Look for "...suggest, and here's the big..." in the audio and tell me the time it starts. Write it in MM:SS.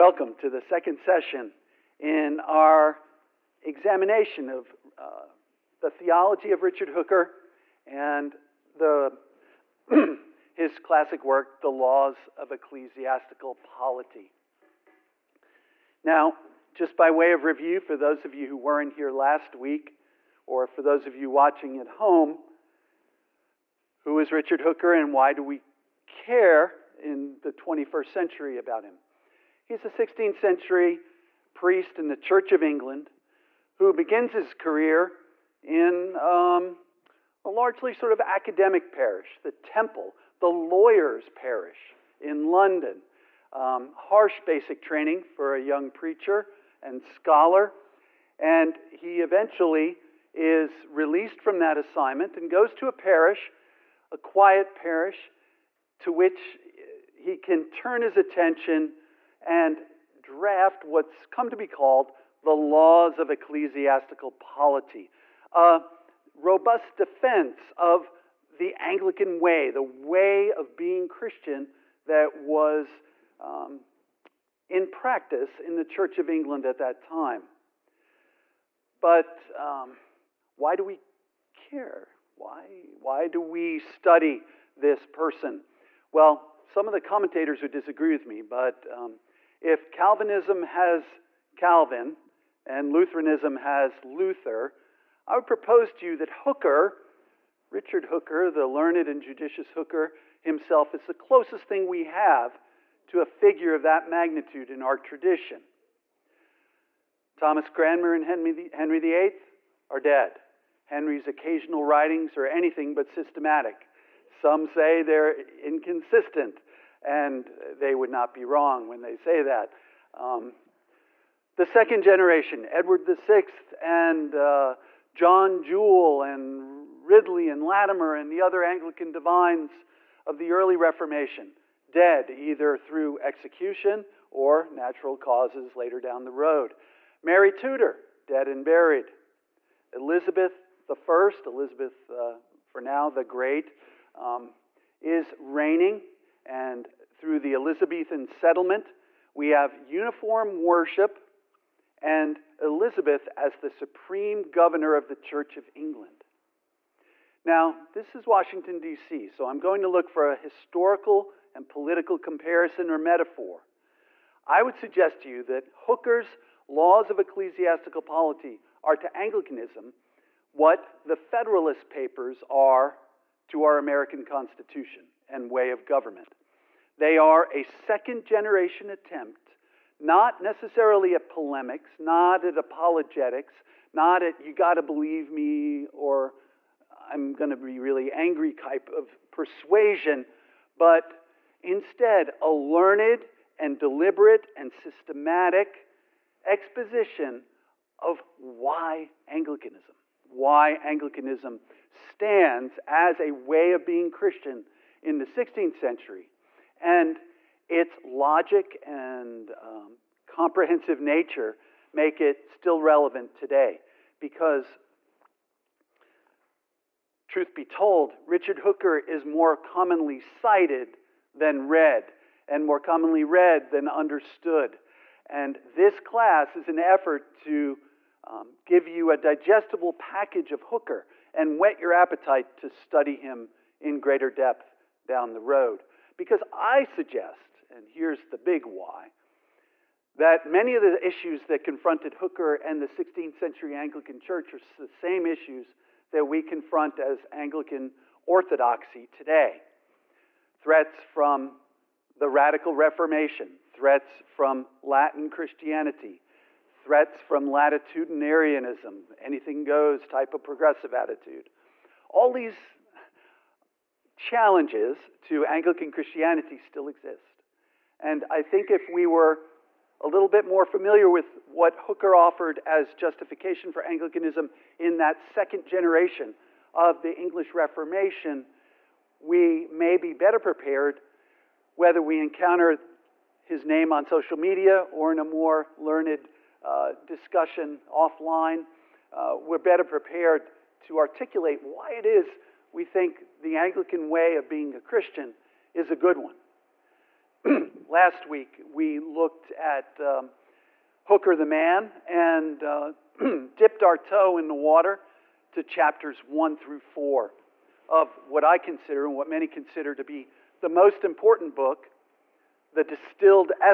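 03:56.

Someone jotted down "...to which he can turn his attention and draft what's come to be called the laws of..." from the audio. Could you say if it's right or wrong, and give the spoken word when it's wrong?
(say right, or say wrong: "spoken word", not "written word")
right.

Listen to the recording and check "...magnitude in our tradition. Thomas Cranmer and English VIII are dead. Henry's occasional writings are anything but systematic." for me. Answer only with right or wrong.
wrong.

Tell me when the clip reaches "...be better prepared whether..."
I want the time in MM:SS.
04:39.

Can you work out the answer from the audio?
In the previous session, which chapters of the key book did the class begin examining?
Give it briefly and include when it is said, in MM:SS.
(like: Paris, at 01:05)
1 through 4, at 05:05.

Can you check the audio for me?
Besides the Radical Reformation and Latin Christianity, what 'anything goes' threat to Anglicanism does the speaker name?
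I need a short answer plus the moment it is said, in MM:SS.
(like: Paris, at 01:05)
Latitudinarianism, at 04:17.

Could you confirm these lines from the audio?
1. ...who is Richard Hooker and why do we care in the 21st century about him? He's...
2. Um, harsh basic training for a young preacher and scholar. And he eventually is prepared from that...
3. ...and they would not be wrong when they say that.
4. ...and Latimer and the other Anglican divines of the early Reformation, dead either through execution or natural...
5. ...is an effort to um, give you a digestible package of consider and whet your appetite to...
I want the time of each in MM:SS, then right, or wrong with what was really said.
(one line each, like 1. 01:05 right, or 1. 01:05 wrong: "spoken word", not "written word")
1. 00:24 right
2. 00:43 wrong: "released", not "prepared"
3. 01:57 right
4. 02:07 right
5. 03:46 wrong: "hooker", not "consider".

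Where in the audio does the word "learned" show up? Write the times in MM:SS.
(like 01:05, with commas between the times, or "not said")
01:38, 03:12, 04:45.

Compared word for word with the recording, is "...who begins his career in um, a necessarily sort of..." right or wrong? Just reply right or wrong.
wrong.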